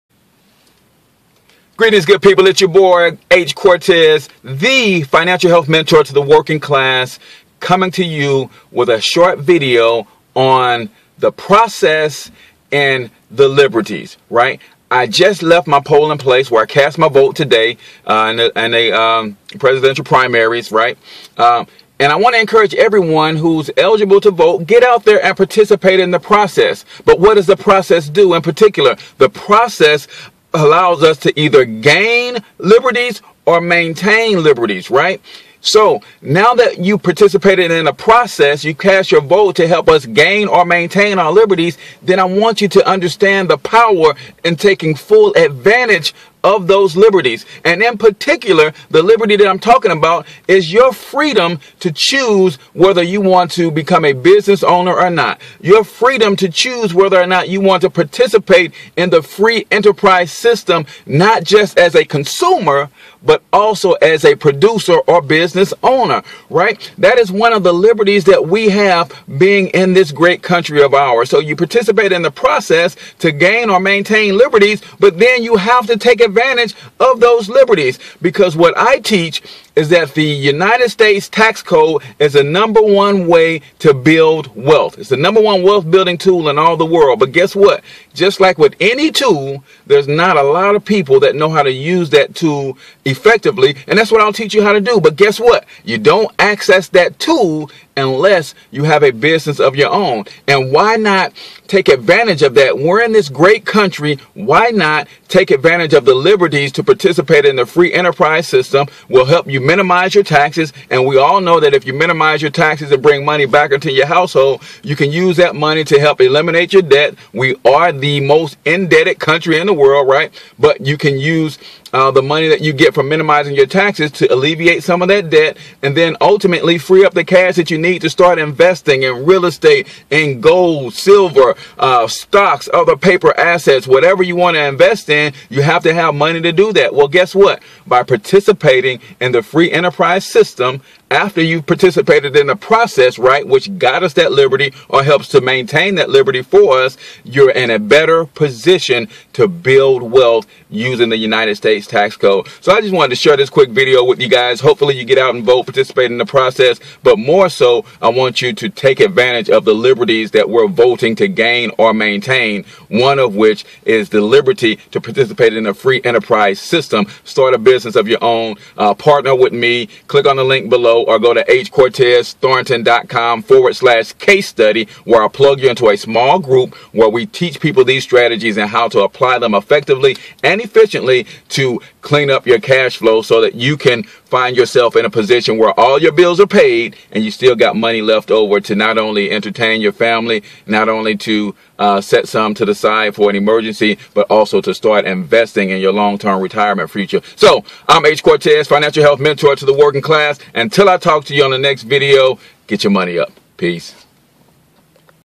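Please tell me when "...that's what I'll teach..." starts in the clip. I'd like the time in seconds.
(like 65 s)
93 s.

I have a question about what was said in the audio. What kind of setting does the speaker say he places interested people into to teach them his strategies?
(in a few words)
a small group.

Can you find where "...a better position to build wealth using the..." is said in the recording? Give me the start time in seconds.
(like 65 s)
147 s.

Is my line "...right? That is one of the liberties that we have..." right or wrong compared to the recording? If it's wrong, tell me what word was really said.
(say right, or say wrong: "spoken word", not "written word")
right.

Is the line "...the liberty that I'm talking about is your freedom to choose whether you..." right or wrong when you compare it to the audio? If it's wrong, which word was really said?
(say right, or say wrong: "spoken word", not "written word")
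right.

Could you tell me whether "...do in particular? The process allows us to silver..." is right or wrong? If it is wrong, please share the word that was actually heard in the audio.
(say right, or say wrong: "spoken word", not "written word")
wrong: "either", not "silver".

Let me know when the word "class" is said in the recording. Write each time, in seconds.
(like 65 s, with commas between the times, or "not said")
6 s, 200 s.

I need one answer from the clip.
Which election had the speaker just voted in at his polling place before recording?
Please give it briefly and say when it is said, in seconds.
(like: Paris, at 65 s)
presidential primaries, at 19 s.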